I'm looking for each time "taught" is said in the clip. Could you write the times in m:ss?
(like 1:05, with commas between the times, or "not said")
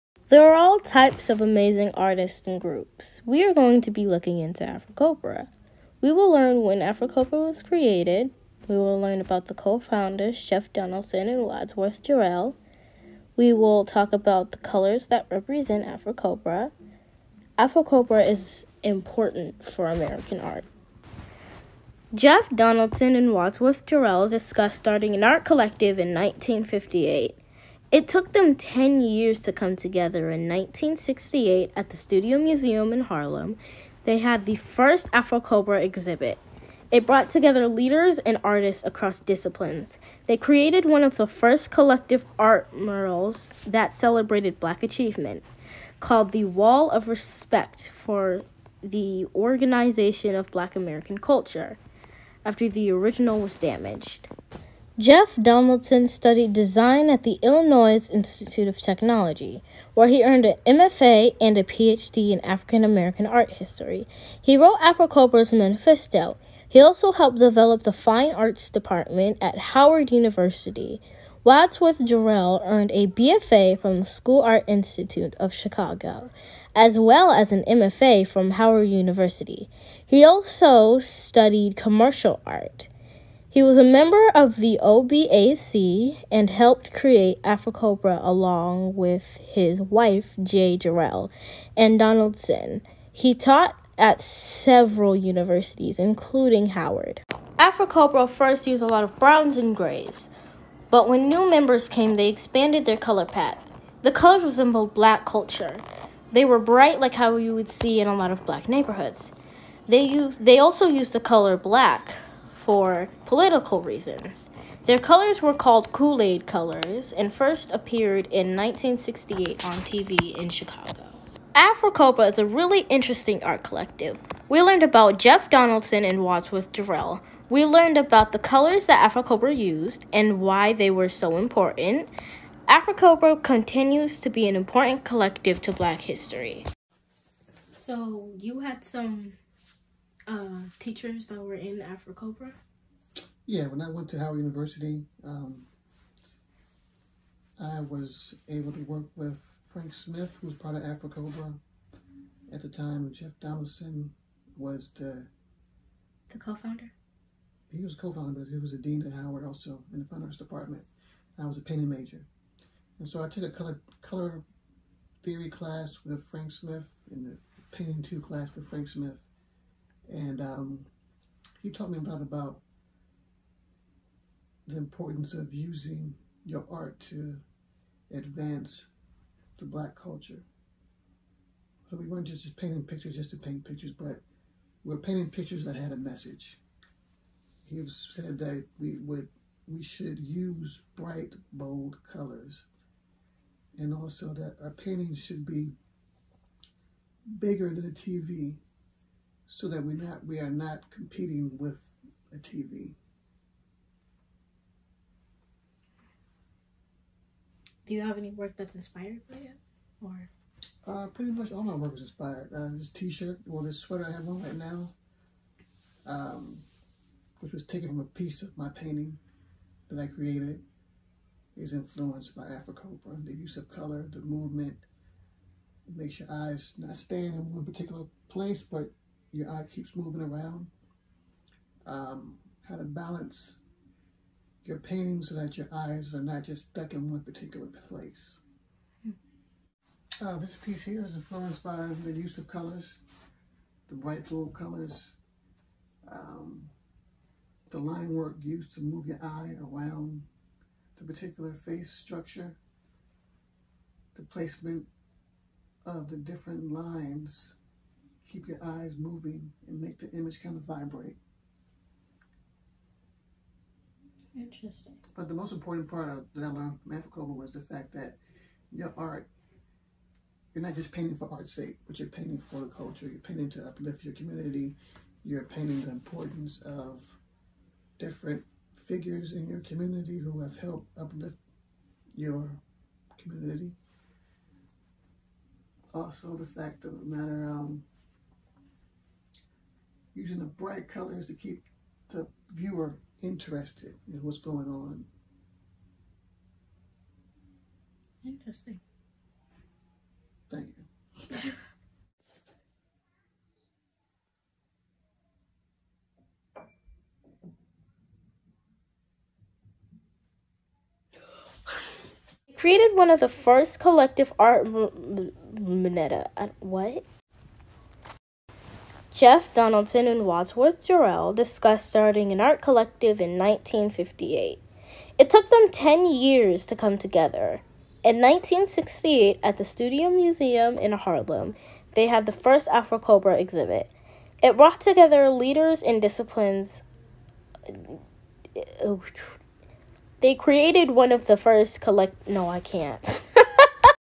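1:33, 2:51.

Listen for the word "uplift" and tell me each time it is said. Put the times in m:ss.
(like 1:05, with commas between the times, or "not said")
4:33, 4:40.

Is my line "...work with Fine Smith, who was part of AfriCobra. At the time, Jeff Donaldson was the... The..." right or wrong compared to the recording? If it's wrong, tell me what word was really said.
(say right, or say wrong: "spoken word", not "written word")
wrong: "Frank", not "Fine".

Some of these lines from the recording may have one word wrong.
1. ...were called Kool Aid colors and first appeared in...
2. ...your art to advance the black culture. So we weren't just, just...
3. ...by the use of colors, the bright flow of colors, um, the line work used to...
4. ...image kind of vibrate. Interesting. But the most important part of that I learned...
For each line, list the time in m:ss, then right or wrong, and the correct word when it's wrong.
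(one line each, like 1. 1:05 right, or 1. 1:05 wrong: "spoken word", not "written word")
1. 1:55 right
2. 2:56 right
3. 4:01 right
4. 4:20 right.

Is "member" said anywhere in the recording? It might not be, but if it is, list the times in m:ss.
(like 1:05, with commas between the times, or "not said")
1:23, 1:41.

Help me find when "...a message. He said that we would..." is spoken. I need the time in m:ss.
3:05.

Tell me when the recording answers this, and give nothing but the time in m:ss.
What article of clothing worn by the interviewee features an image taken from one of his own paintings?
3:33.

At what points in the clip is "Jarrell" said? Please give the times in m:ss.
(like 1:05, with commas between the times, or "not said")
0:12, 0:23, 1:11, 1:30, 2:06, 5:20.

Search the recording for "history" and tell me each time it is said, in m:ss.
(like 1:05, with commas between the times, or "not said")
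1:03, 2:16.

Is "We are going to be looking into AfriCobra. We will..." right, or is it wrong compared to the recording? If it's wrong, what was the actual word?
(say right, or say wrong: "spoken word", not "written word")
right.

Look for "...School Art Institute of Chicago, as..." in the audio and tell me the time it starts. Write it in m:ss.
1:14.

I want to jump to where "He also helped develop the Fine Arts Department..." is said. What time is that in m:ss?
1:06.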